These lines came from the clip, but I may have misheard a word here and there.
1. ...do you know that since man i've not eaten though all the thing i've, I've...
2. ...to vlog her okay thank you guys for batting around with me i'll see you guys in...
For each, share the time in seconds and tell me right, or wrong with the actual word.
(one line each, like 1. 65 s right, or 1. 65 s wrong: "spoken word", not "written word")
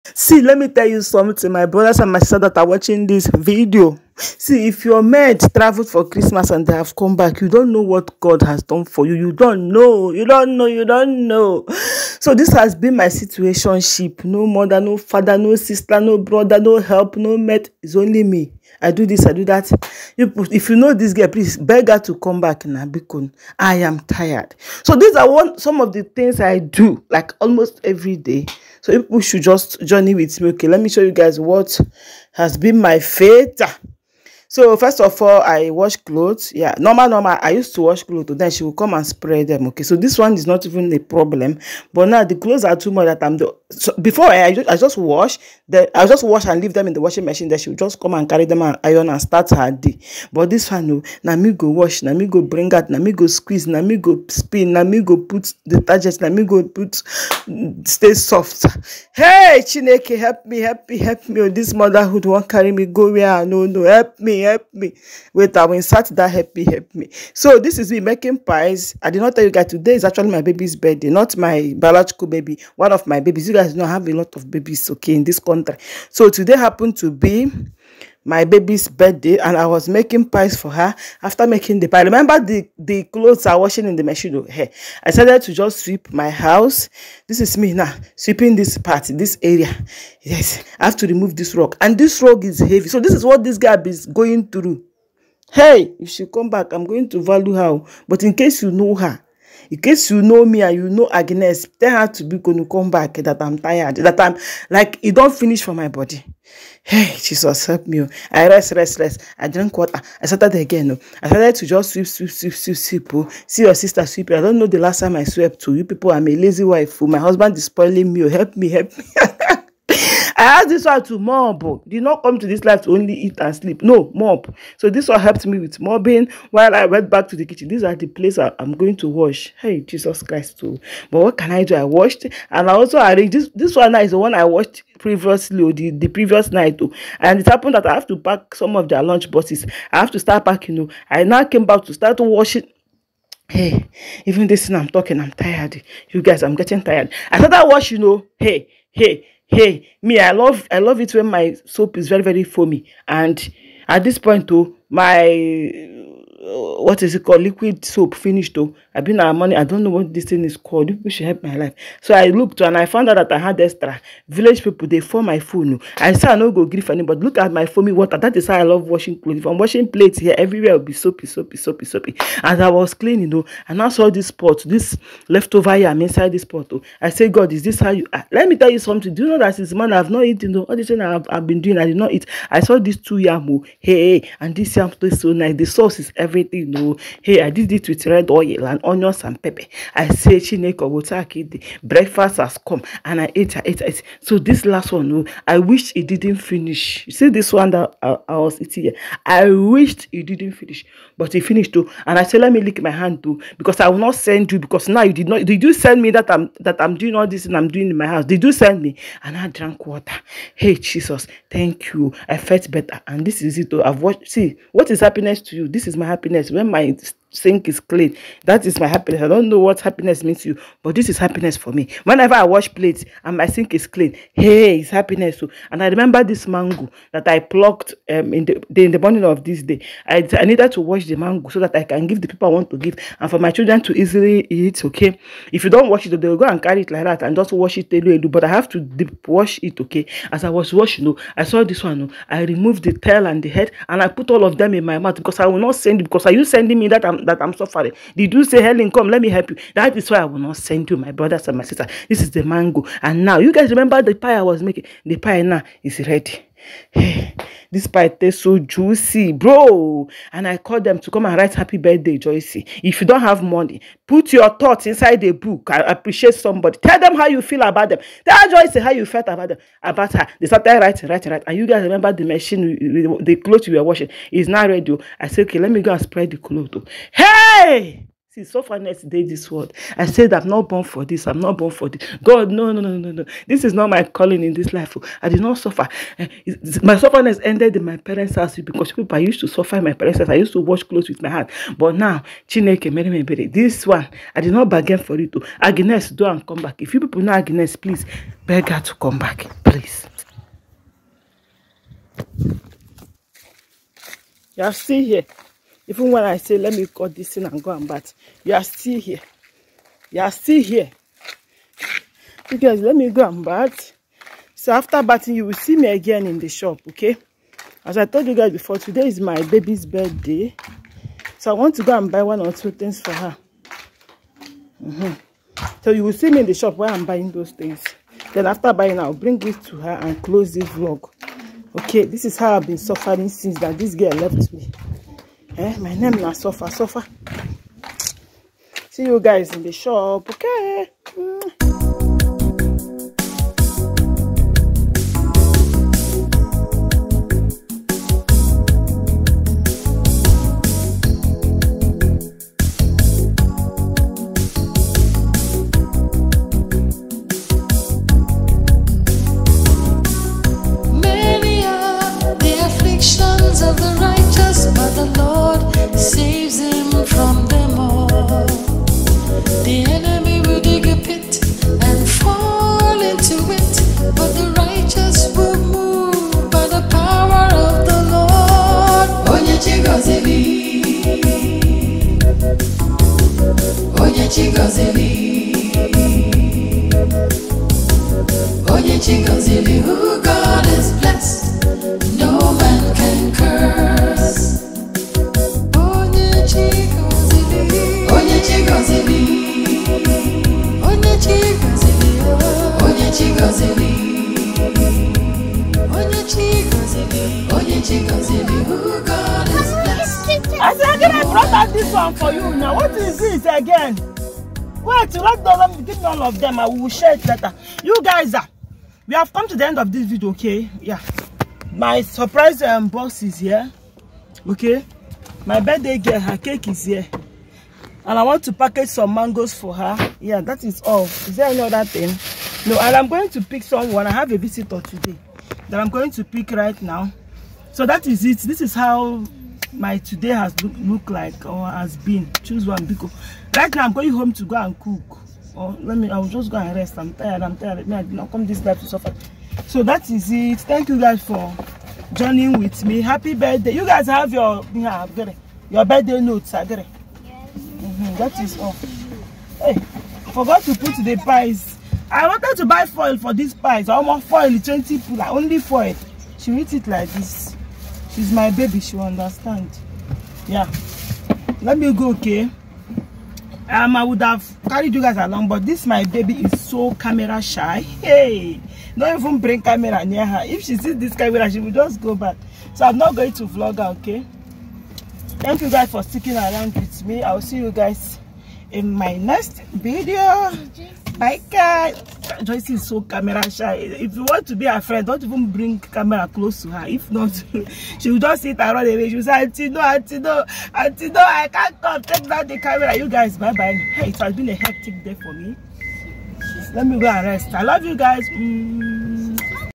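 1. 179 s right
2. 483 s wrong: "sticking", not "batting".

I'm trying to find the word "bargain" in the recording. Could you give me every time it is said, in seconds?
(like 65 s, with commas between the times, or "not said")
294 s.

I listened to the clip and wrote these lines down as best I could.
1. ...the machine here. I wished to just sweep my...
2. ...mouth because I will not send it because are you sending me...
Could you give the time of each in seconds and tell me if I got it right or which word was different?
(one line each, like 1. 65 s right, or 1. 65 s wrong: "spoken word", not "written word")
1. 83 s wrong: "decided", not "wished"
2. 244 s right.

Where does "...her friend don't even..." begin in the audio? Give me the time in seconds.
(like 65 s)
494 s.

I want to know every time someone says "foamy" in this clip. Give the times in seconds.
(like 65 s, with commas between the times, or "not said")
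152 s, 167 s.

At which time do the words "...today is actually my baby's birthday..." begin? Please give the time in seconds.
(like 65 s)
69 s.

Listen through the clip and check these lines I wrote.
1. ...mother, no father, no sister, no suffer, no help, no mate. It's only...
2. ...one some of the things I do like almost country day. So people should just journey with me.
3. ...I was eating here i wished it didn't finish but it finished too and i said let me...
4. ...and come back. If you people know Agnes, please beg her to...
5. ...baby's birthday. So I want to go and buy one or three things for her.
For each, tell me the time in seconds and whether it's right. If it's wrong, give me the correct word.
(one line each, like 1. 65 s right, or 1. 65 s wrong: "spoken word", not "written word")
1. 14 s wrong: "brother", not "suffer"
2. 25 s wrong: "every", not "country"
3. 198 s right
4. 296 s right
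5. 319 s wrong: "two", not "three".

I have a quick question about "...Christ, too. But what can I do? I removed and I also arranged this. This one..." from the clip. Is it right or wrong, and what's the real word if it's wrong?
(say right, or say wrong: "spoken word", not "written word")
wrong: "washed", not "removed".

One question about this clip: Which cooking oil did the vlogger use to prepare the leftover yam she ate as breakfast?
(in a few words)
red oil.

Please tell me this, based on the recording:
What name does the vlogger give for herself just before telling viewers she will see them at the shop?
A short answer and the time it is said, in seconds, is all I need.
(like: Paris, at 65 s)
Sofa Sofa, at 336 s.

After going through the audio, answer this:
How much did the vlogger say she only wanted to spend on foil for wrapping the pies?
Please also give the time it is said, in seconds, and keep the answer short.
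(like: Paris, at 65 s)
20 pula, at 464 s.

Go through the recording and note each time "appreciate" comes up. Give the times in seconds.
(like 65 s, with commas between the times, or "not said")
265 s.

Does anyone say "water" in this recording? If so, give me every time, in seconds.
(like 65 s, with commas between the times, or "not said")
109 s, 167 s, 209 s.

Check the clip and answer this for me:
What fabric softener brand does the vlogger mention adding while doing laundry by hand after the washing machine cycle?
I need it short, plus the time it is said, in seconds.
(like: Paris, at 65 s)
Sta-Soft, at 57 s.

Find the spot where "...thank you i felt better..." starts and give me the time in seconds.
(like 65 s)
211 s.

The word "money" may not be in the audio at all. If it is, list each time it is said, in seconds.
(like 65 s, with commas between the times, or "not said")
159 s, 263 s.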